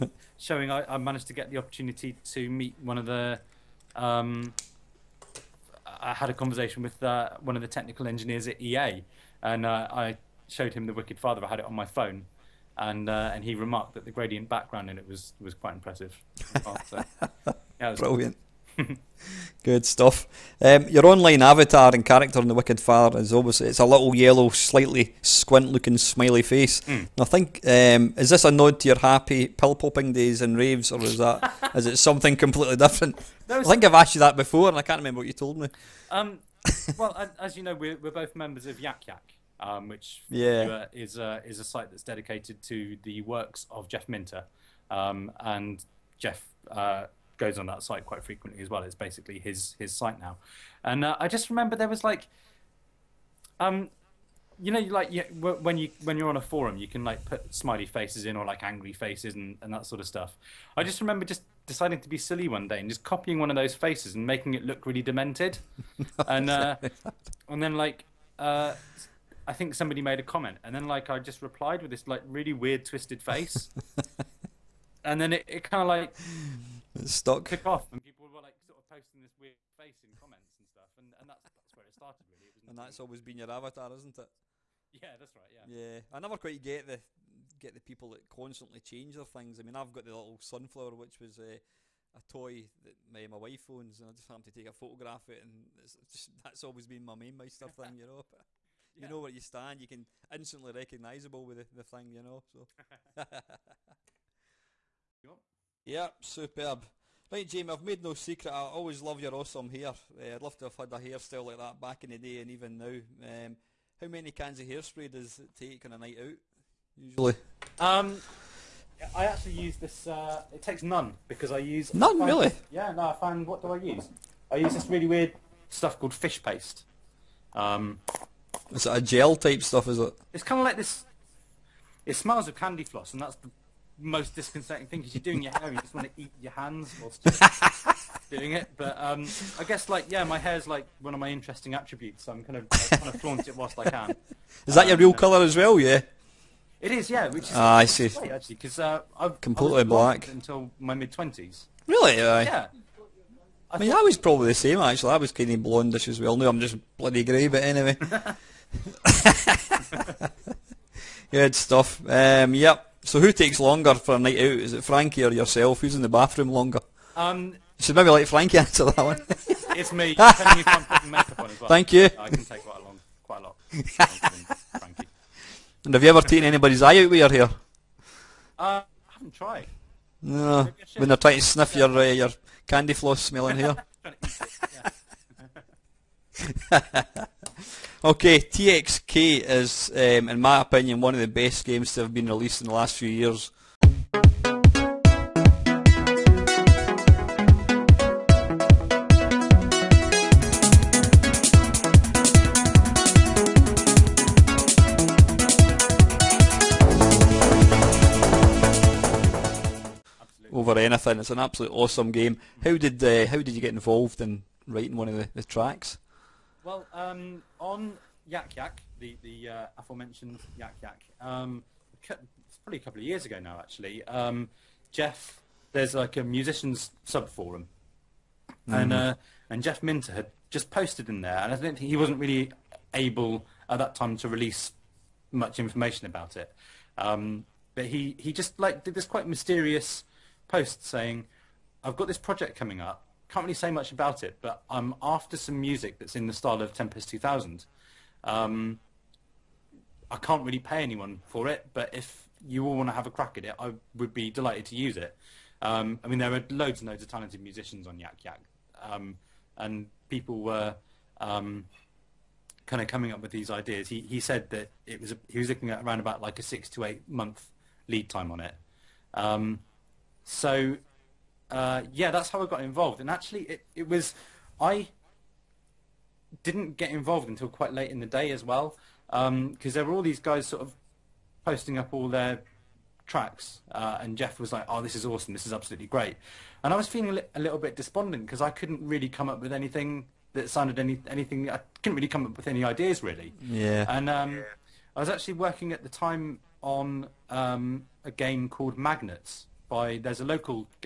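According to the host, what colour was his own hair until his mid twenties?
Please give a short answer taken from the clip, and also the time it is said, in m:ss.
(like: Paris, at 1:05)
Black, at 2:29.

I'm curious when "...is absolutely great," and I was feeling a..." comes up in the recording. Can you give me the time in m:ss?
4:45.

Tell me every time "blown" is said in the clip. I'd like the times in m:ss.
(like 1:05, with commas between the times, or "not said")
not said.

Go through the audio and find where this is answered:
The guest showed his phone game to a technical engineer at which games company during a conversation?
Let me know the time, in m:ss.
0:08.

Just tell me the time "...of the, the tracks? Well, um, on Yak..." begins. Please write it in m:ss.
3:35.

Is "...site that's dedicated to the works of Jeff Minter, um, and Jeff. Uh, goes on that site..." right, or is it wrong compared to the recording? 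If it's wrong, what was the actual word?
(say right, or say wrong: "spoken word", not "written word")
right.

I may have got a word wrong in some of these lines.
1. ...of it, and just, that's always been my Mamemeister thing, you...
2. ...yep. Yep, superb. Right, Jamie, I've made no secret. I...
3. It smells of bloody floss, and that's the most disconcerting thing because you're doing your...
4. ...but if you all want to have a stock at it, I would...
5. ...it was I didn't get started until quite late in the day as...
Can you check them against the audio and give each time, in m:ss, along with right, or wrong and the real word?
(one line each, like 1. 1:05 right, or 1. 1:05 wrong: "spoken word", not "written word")
1. 1:35 right
2. 1:45 right
3. 2:12 wrong: "candy", not "bloody"
4. 4:11 wrong: "crack", not "stock"
5. 4:33 wrong: "involved", not "started".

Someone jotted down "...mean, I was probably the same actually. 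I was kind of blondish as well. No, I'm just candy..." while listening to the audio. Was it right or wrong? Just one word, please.
wrong.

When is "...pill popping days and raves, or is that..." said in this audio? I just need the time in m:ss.
0:29.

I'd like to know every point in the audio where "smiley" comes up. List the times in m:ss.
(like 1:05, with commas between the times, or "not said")
0:25, 0:57.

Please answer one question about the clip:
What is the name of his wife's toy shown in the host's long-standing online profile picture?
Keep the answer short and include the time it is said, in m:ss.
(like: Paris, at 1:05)
Sunflower, at 1:30.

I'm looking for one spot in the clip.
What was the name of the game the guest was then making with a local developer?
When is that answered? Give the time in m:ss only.
4:58.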